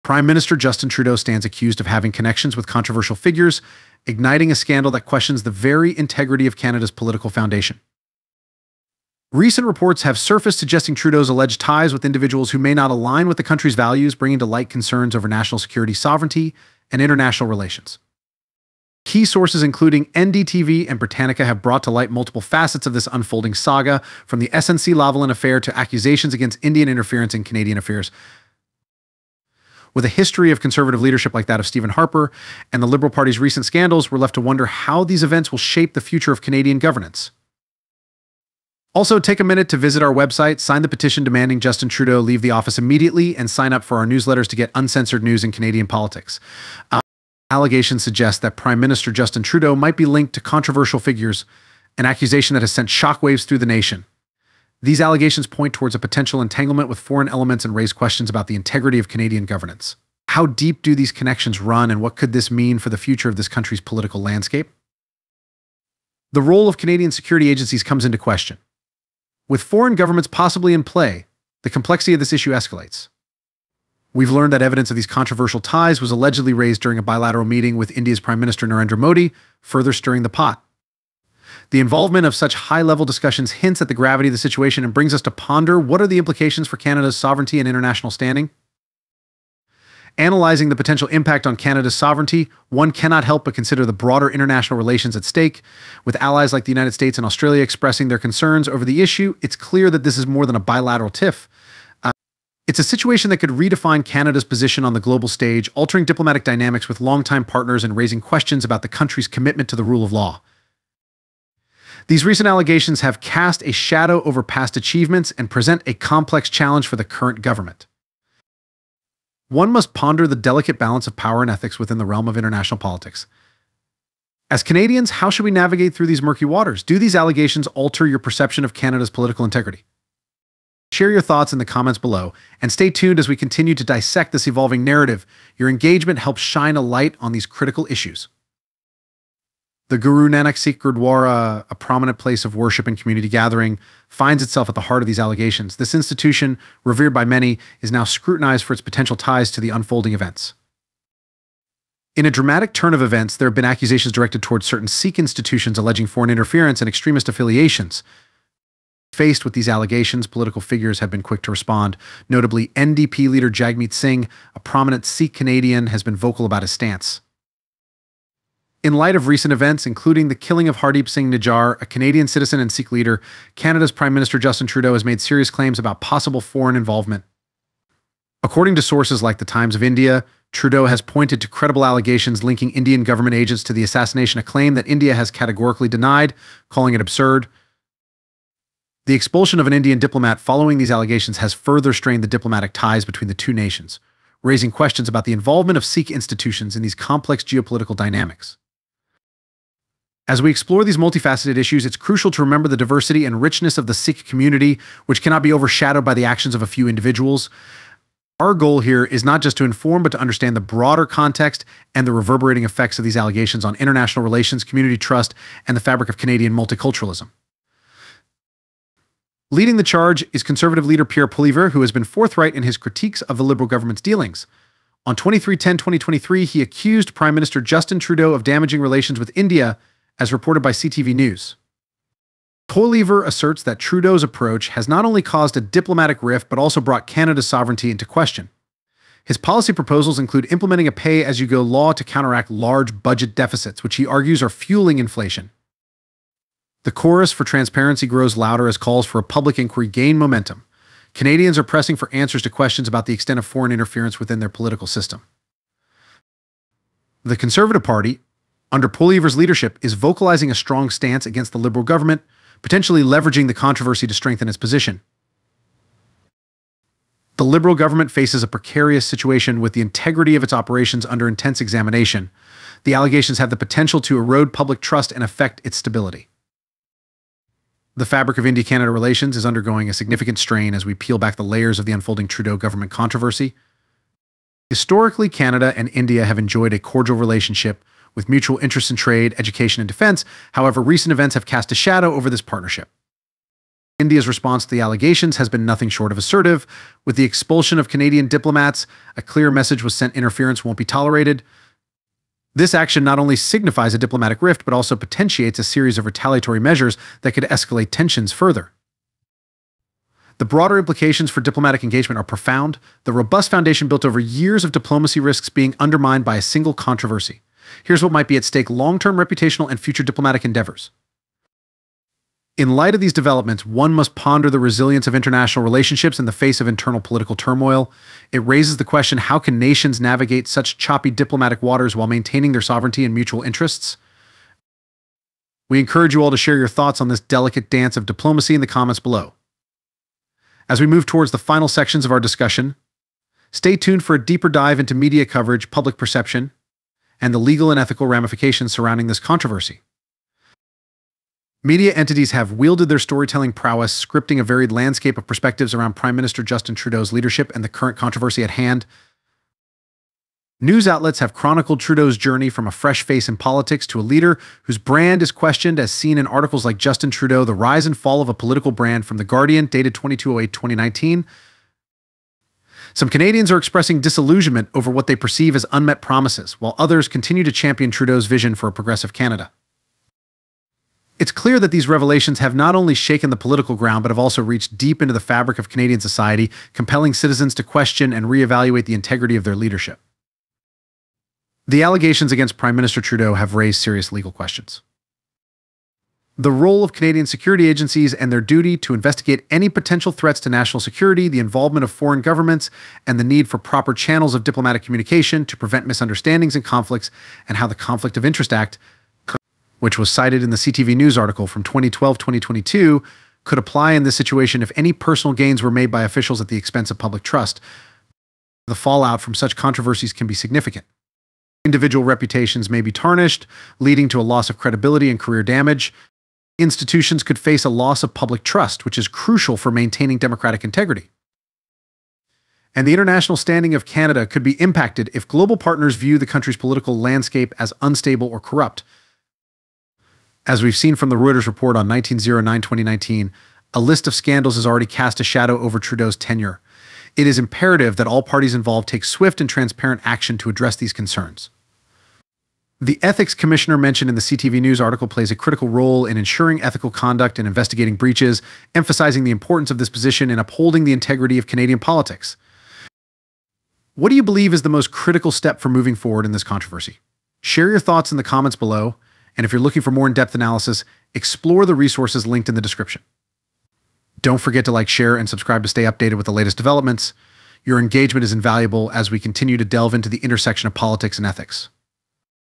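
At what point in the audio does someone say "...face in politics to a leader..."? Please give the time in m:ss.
6:03.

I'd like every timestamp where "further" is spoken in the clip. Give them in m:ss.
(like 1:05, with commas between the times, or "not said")
1:19, 3:11, 5:08.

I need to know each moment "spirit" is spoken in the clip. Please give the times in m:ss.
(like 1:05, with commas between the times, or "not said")
not said.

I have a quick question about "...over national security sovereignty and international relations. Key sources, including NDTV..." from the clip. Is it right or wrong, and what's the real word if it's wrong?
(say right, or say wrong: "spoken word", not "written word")
right.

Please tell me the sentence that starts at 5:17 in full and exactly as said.
Here's what might be at stake long term reputational and future diplomatic endeavors.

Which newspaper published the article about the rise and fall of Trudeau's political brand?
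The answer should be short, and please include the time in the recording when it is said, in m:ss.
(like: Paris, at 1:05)
The Guardian, at 6:09.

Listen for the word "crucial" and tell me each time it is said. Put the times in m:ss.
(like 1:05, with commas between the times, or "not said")
3:21, 7:09.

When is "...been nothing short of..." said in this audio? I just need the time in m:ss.
4:55.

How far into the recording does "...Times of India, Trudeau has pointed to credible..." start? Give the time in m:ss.
2:59.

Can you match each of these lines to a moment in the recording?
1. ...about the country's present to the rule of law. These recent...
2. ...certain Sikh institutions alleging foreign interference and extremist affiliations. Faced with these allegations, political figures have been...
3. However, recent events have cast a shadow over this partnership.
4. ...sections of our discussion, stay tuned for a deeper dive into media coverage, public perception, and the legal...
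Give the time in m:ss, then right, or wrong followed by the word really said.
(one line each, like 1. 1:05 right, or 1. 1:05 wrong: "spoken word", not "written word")
1. 1:48 wrong: "commitment", not "present"
2. 2:34 right
3. 4:50 right
4. 5:41 right.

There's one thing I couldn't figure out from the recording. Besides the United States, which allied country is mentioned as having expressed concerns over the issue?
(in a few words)
Australia.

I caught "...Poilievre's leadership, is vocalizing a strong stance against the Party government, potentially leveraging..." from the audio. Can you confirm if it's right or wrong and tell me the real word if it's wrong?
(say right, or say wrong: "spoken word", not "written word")
wrong: "Liberal", not "Party".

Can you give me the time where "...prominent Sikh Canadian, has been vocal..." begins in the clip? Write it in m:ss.
2:44.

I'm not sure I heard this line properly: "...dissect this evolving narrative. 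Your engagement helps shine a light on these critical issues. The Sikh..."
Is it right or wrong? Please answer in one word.
wrong.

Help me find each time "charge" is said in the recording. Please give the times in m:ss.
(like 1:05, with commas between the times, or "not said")
3:39.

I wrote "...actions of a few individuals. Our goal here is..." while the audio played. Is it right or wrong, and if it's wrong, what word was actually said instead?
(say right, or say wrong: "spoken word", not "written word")
right.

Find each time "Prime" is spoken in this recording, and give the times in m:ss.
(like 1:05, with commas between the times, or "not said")
0:00, 0:48, 1:18, 2:53, 3:47, 5:55, 6:32.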